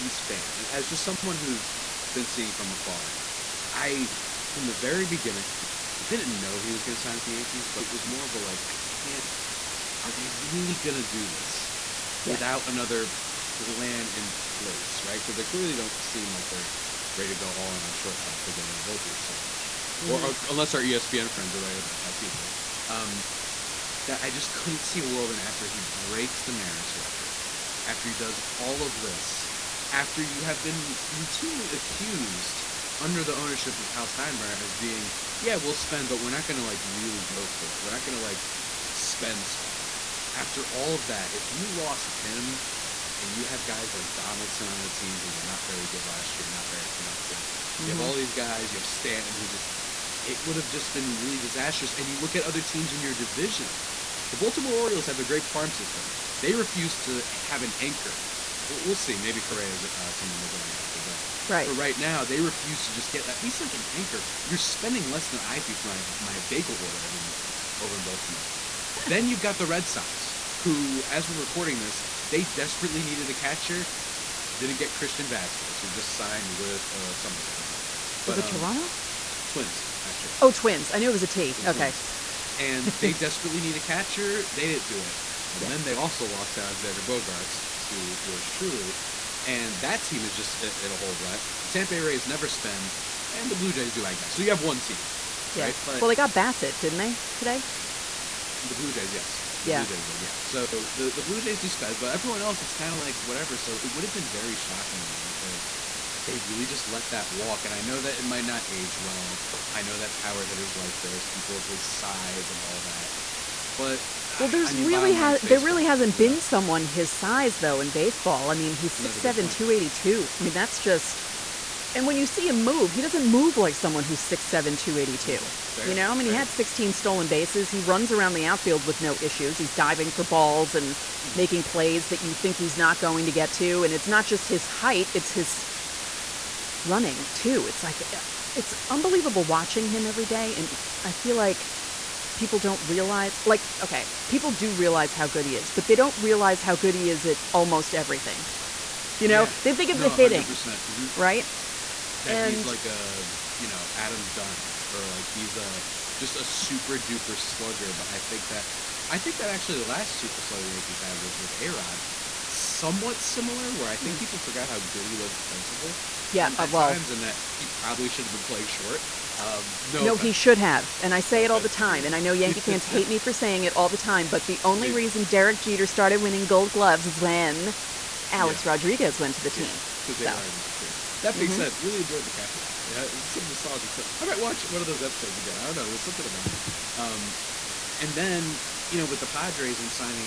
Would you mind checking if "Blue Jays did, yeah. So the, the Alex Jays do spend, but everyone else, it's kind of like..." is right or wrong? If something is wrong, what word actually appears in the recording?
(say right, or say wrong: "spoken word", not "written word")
wrong: "Blue", not "Alex".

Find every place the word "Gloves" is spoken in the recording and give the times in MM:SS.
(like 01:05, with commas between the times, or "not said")
02:56.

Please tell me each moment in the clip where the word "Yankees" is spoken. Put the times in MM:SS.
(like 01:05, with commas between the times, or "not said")
00:07, 02:40, 02:52.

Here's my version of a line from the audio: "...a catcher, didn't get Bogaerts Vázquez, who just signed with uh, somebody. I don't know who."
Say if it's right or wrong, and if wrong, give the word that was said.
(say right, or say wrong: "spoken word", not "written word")
wrong: "Christian", not "Bogaerts".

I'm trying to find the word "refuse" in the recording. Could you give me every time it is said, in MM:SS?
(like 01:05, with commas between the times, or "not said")
00:56, 01:02.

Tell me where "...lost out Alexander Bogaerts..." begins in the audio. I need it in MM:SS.
01:26.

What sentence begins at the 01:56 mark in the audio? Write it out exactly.
someone his size though in baseball.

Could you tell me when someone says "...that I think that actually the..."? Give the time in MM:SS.
02:38.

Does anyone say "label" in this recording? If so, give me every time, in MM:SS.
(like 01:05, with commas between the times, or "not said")
not said.